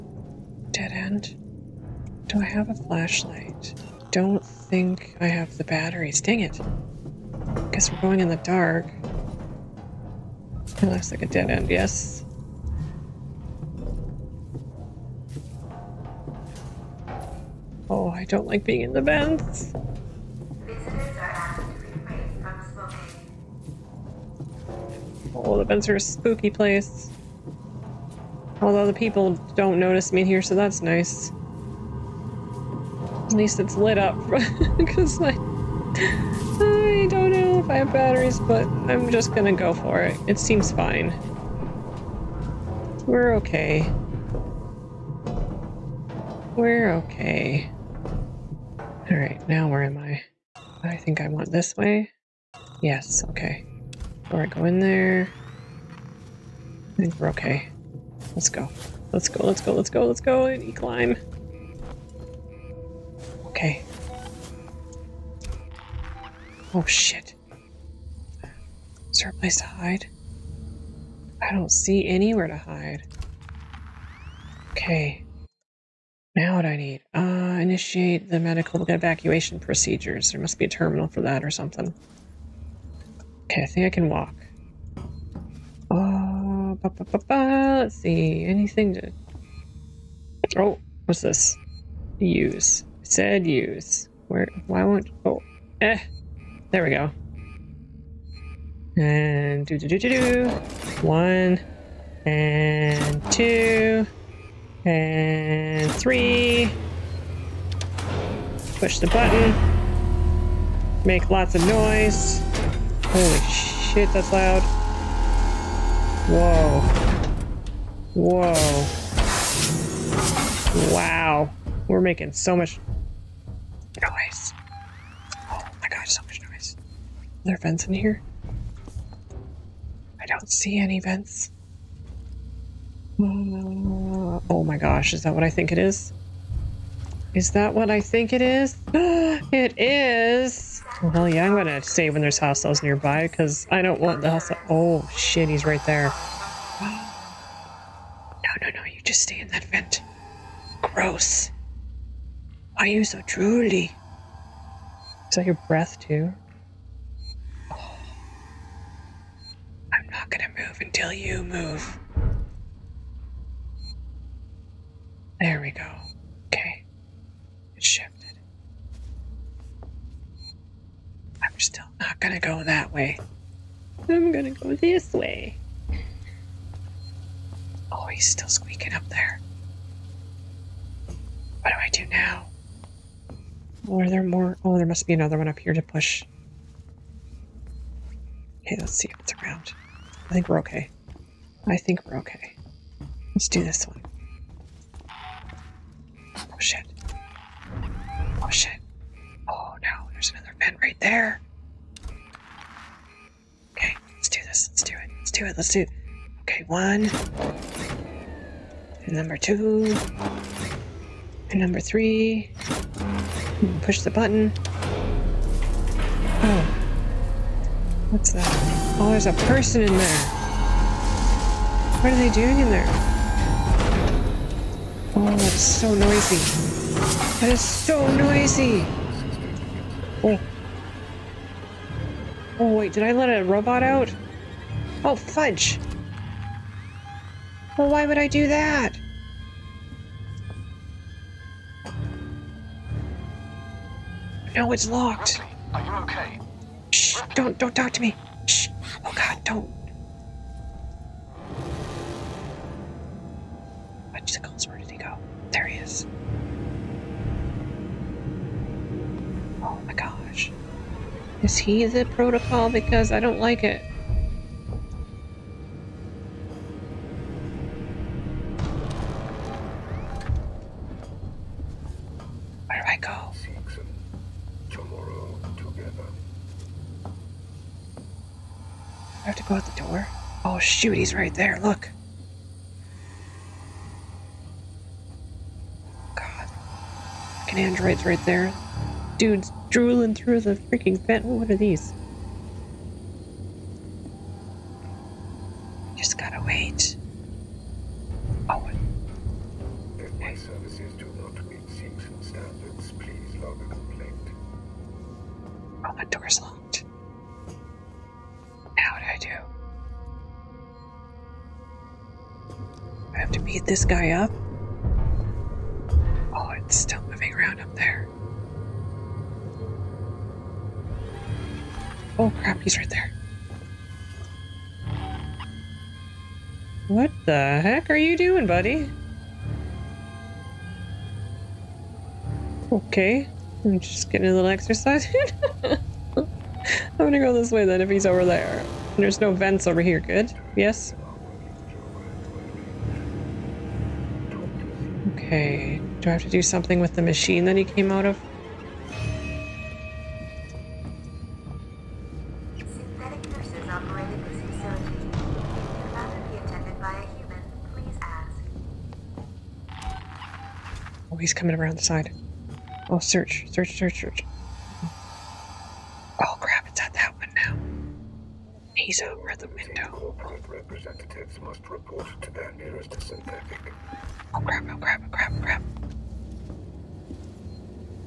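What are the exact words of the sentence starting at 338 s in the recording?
There's no vents over here, good?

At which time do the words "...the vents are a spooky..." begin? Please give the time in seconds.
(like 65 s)
25 s.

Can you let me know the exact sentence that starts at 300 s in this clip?
My services do not meet Seegson standards.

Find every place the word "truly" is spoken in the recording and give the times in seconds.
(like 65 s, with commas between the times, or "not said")
153 s.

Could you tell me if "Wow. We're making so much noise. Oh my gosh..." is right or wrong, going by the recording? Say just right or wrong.
right.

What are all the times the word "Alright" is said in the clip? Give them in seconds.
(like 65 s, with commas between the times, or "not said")
49 s, 54 s.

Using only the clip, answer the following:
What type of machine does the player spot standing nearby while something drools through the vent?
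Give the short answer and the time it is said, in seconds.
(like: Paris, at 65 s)
An android, at 287 s.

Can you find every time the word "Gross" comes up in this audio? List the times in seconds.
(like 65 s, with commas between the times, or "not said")
150 s.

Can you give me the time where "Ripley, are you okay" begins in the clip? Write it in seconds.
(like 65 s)
245 s.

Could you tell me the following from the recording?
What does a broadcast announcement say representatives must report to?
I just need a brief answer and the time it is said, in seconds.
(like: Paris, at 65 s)
Their nearest synthetic, at 372 s.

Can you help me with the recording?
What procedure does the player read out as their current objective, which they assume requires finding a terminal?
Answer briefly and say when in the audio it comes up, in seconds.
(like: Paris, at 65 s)
Medical evacuation procedures, at 78 s.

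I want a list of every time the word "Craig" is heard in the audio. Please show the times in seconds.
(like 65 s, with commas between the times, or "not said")
not said.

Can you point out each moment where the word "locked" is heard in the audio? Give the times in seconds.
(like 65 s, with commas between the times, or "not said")
244 s, 306 s.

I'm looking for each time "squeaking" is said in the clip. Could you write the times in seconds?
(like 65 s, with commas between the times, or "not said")
178 s.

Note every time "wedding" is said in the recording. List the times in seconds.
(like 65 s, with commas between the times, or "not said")
not said.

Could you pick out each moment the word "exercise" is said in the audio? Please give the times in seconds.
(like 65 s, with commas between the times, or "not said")
334 s.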